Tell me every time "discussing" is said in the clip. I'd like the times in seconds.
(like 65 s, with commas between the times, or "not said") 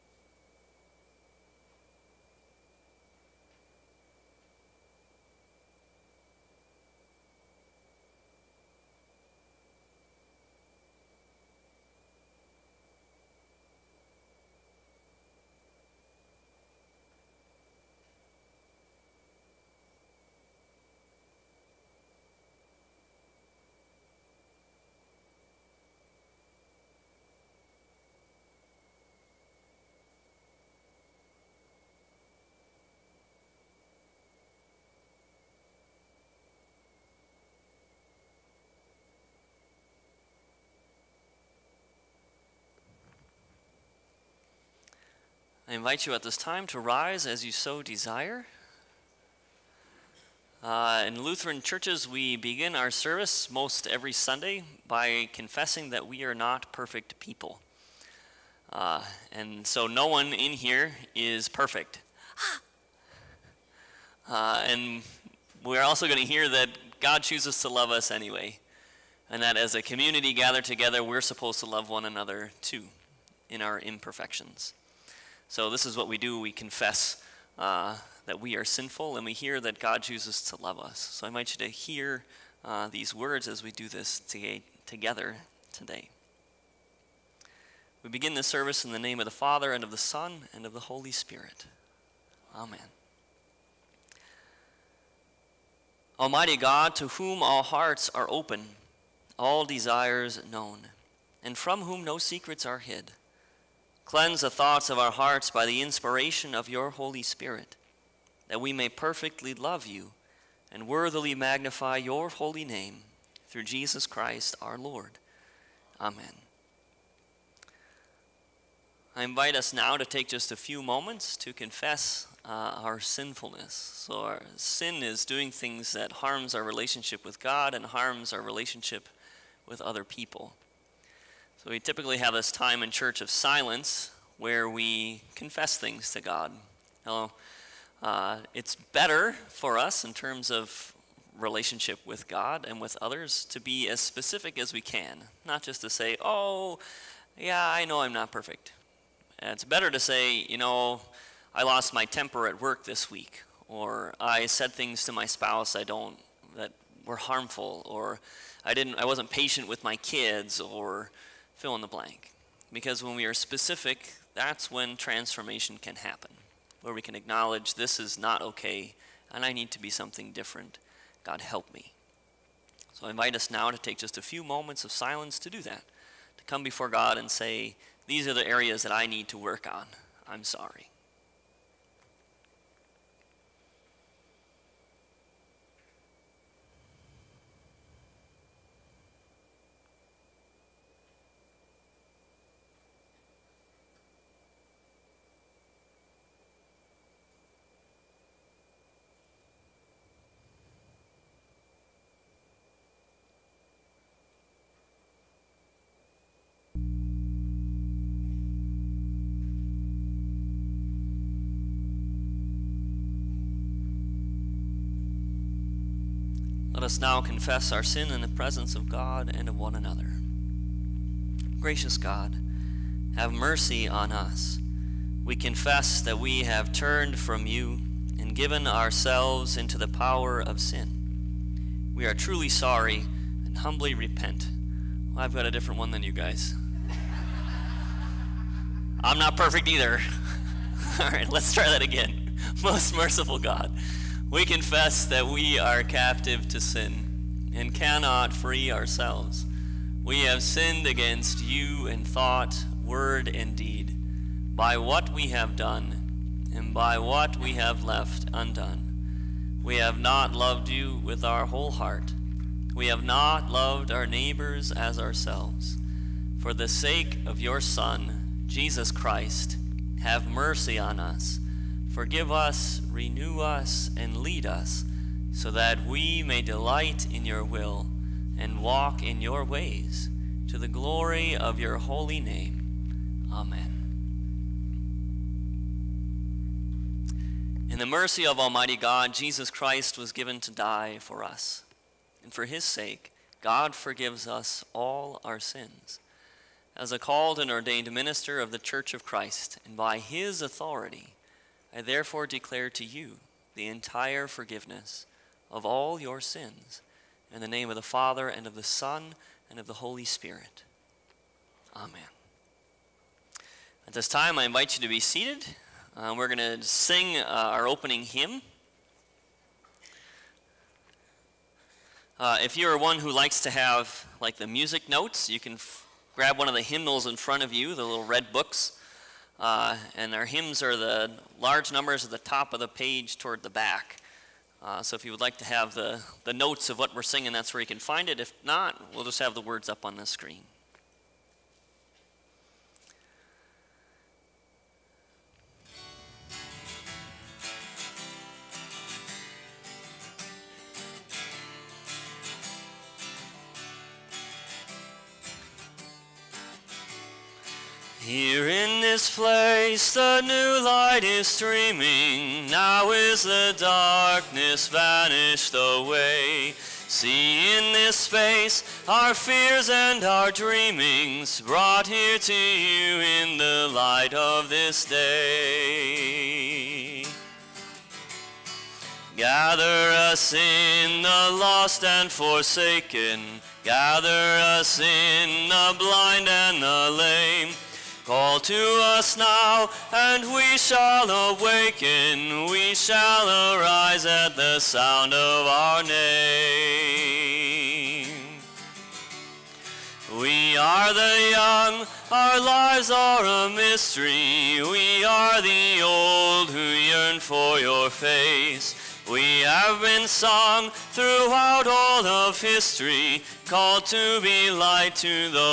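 not said.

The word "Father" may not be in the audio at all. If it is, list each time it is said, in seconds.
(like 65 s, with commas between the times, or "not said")
89 s, 307 s.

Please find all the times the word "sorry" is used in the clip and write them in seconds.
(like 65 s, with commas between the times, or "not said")
180 s, 232 s.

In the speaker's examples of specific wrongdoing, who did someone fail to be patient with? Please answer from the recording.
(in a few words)
kids.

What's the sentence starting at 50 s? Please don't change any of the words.
Uh, in Lutheran churches, we begin our service most every Sunday by confessing that we are not perfect people.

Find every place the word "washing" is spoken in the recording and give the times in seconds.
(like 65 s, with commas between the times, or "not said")
not said.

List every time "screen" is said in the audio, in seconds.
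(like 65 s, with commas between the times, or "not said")
340 s.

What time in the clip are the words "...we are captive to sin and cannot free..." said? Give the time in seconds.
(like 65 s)
245 s.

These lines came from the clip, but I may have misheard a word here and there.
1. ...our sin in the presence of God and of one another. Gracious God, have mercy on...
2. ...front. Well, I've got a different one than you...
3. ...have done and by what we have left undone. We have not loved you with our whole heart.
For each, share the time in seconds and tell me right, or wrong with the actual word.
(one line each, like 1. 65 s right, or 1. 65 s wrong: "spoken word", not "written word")
1. 217 s right
2. 233 s wrong: "repent", not "front"
3. 255 s right.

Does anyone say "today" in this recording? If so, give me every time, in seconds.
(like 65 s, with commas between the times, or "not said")
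85 s.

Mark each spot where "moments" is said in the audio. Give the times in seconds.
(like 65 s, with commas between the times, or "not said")
120 s, 174 s.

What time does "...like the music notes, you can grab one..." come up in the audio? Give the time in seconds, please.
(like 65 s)
324 s.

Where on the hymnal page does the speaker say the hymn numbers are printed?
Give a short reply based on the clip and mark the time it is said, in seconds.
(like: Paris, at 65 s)
at the top, at 332 s.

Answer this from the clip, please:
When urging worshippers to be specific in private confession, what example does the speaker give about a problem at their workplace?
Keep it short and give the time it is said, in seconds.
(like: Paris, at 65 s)
lost my temper at work, at 151 s.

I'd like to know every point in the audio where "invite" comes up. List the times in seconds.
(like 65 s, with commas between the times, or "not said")
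45 s, 81 s, 119 s, 173 s, 314 s.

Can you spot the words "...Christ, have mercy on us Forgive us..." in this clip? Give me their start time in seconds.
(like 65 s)
268 s.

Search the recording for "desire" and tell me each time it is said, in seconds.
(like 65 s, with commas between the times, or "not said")
47 s, 99 s.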